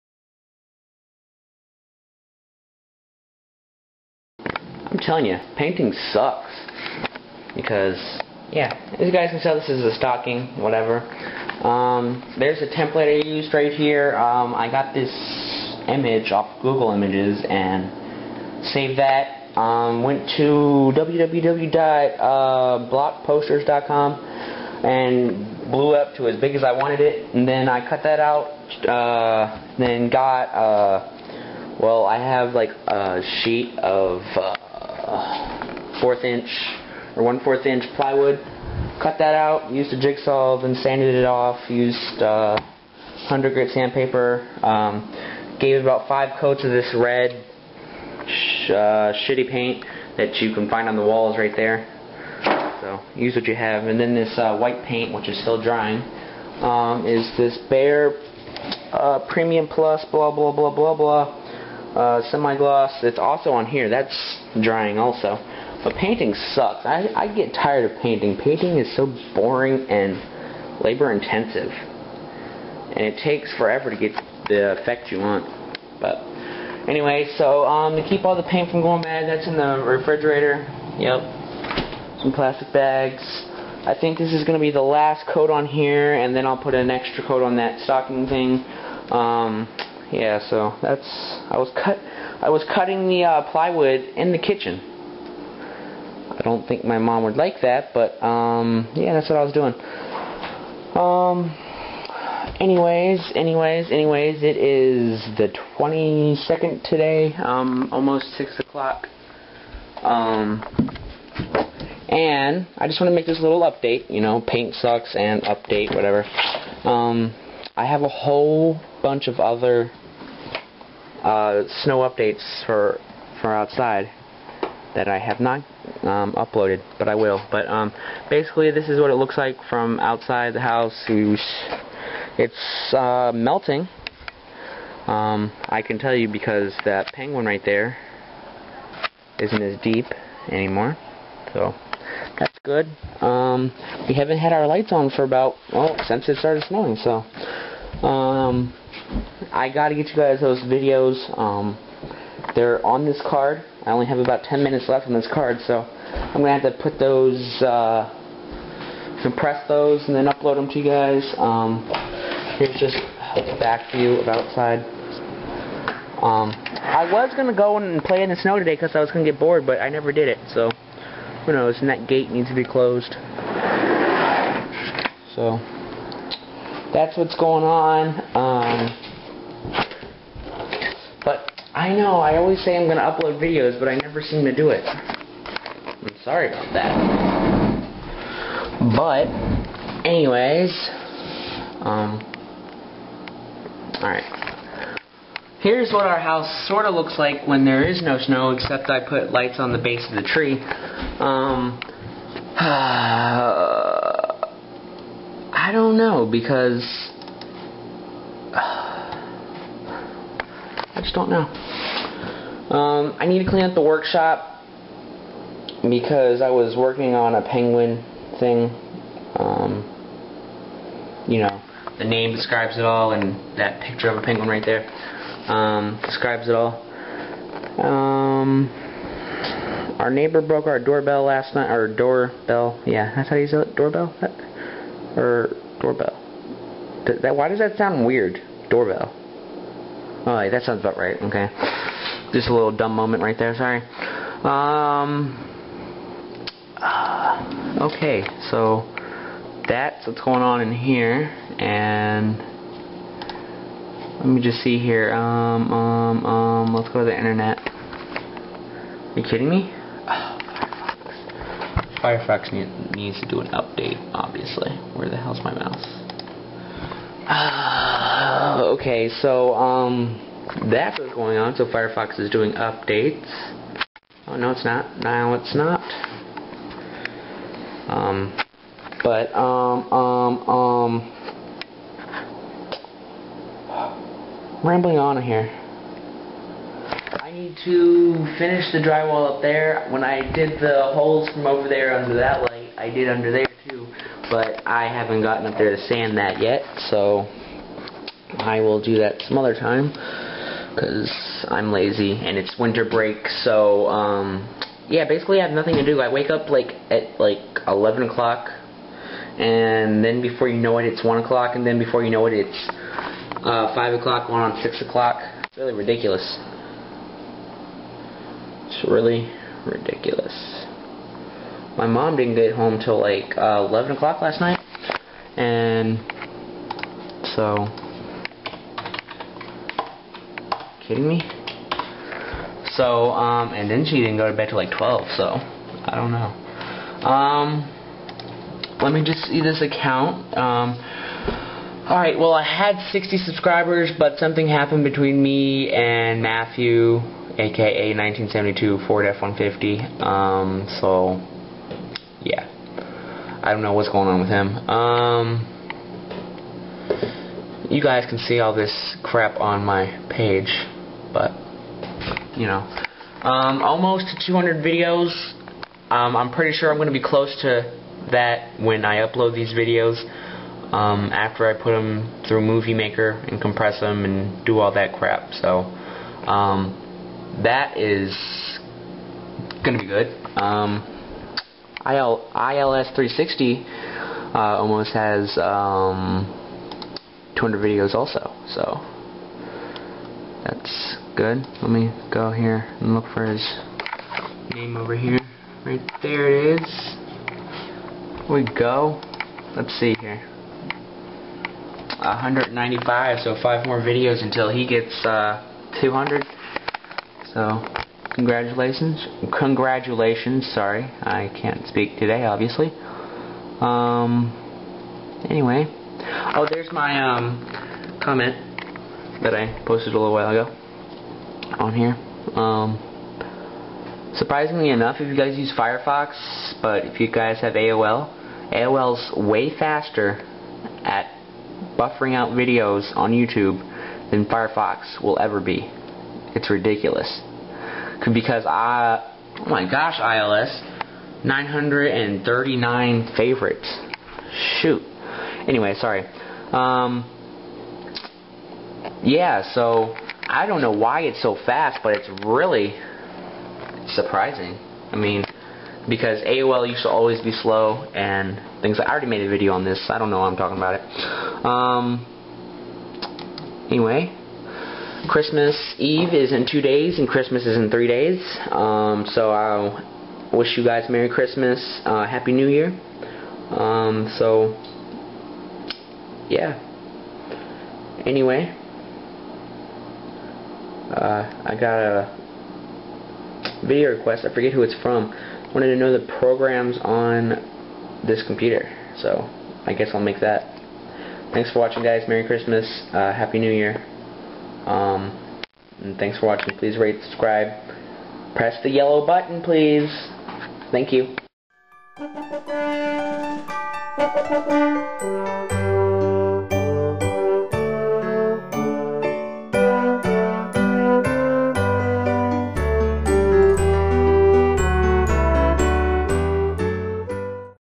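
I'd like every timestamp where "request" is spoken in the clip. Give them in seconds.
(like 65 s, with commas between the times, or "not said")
483 s.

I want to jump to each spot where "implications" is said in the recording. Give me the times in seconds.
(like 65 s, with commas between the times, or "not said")
not said.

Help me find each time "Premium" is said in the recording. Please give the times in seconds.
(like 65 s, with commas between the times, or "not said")
59 s.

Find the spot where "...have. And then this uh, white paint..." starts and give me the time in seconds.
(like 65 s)
53 s.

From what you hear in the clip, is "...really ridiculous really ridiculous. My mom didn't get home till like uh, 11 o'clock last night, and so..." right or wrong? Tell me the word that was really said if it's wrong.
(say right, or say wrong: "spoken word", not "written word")
right.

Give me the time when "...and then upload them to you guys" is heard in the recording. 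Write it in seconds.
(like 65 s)
160 s.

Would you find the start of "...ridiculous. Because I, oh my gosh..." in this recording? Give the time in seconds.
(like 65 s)
436 s.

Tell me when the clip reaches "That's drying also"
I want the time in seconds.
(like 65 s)
63 s.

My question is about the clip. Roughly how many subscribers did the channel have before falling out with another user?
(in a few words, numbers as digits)
60.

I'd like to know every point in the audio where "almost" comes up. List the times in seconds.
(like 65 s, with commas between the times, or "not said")
107 s, 363 s, 384 s.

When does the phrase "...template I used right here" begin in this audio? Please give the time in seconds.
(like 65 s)
12 s.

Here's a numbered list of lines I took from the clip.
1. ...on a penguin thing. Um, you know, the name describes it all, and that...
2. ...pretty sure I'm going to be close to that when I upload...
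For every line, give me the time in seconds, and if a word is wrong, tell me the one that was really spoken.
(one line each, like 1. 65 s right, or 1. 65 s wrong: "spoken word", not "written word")
1. 217 s right
2. 366 s right.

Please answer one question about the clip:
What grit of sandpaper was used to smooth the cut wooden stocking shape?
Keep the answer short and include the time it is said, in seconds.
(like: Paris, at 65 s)
100, at 43 s.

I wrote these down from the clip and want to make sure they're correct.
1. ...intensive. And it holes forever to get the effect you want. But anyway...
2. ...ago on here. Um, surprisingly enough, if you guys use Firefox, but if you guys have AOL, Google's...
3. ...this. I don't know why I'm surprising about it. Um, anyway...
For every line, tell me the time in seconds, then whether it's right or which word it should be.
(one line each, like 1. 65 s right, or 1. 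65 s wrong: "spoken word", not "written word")
1. 71 s wrong: "takes", not "holes"
2. 420 s wrong: "AOL", not "Google"
3. 459 s wrong: "talking", not "surprising".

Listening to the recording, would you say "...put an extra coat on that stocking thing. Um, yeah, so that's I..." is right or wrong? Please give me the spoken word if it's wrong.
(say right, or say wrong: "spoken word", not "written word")
right.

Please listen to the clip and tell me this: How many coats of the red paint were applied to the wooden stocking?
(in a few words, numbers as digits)
5.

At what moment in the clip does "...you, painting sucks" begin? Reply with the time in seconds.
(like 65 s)
5 s.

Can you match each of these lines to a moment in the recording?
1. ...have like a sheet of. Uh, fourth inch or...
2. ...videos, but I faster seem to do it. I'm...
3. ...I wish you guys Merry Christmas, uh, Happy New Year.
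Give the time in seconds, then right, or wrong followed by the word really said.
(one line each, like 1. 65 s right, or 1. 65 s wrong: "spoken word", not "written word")
1. 32 s right
2. 183 s wrong: "never", not "faster"
3. 469 s right.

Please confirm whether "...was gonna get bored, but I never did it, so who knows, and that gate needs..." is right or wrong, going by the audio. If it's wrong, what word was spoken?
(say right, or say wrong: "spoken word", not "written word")
right.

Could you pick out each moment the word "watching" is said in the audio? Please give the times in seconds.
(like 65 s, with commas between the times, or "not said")
491 s, 496 s.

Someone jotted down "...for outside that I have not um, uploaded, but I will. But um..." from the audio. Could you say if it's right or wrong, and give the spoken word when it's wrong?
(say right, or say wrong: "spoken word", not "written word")
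right.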